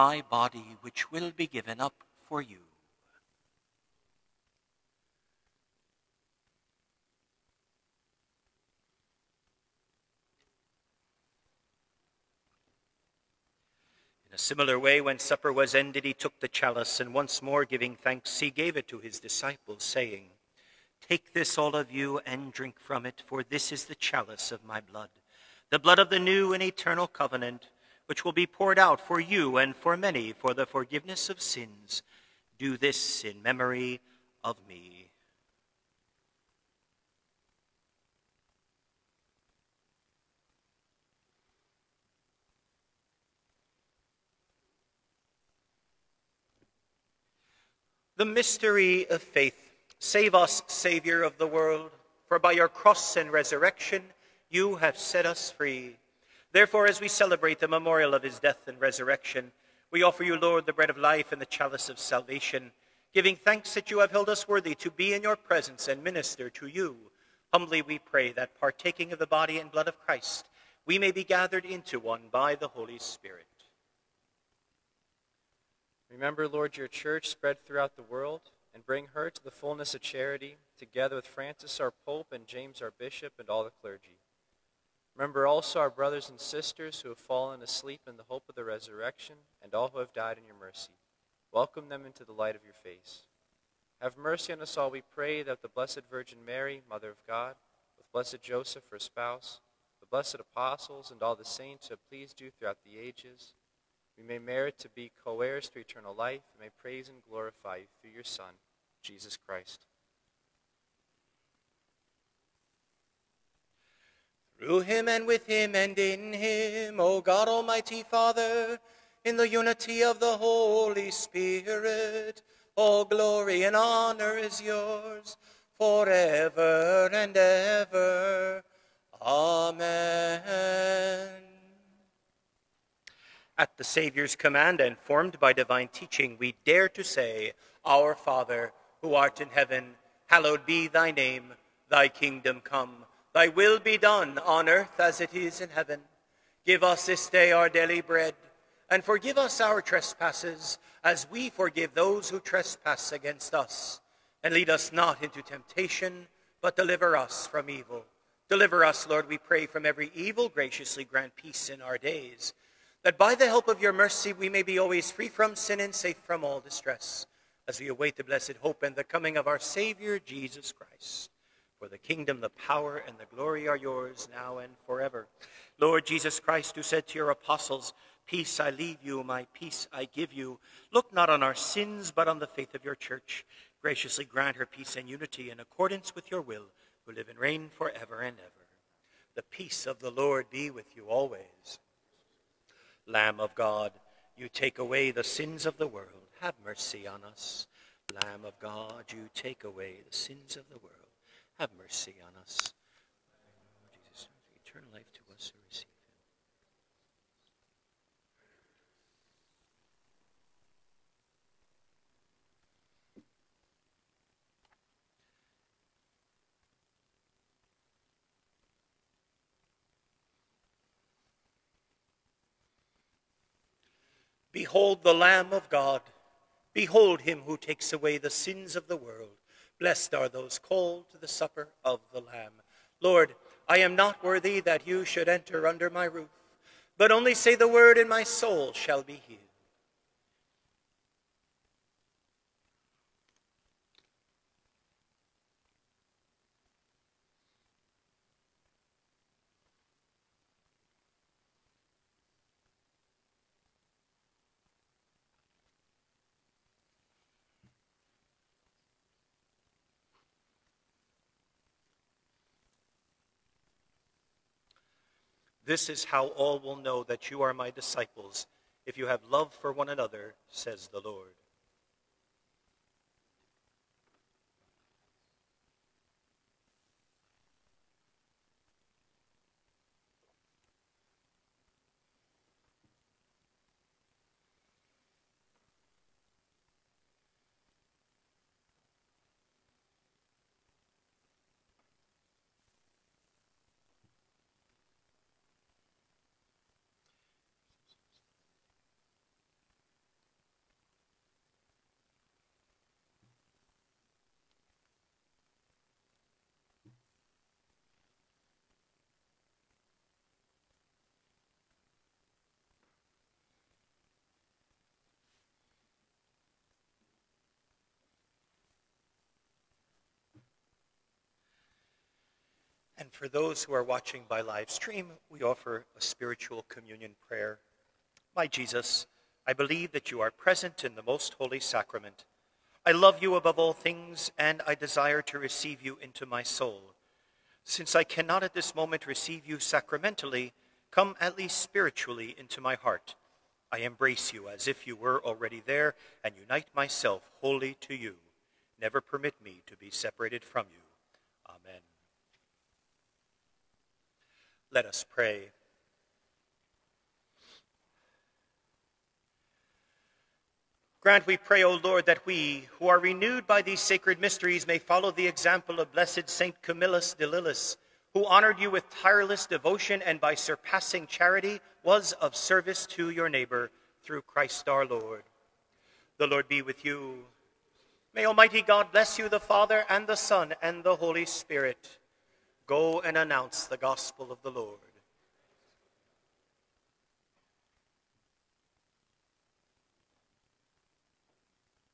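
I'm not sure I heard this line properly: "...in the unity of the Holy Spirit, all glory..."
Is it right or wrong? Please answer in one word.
right.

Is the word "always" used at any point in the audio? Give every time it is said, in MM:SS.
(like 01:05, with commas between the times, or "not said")
02:44, 03:11.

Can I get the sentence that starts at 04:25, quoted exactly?
This is how all will know that you are my disciples, if you have love for one another, says the Lord.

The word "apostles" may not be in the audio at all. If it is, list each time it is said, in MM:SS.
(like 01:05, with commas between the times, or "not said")
01:40, 02:57.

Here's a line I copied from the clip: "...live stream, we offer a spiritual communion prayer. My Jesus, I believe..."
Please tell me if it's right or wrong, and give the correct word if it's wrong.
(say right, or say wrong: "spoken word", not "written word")
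right.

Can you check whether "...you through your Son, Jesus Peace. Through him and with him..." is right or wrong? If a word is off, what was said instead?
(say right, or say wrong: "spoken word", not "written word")
wrong: "Christ", not "Peace".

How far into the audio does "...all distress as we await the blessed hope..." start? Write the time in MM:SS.
02:46.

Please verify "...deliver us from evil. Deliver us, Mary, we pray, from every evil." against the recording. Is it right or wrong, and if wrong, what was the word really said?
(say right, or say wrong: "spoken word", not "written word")
wrong: "Lord", not "Mary".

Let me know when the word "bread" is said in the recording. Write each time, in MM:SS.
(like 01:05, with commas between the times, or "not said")
01:00, 02:28.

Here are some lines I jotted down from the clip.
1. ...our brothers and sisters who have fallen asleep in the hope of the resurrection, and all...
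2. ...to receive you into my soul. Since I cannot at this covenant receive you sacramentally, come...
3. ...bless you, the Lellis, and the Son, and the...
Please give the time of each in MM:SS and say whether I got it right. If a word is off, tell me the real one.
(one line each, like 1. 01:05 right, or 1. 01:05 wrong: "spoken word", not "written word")
1. 01:25 right
2. 05:35 wrong: "moment", not "covenant"
3. 06:18 wrong: "Father", not "Lellis".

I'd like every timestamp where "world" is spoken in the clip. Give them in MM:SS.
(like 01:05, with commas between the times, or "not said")
00:51, 01:18, 03:15, 03:20, 03:48.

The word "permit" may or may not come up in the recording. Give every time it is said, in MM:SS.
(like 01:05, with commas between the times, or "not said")
05:49.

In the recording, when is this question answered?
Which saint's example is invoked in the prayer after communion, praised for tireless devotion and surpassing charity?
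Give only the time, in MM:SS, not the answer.
06:06.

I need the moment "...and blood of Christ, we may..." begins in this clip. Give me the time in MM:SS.
01:09.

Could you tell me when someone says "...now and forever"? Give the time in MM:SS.
02:54.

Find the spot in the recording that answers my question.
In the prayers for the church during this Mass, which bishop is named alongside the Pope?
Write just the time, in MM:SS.
01:22.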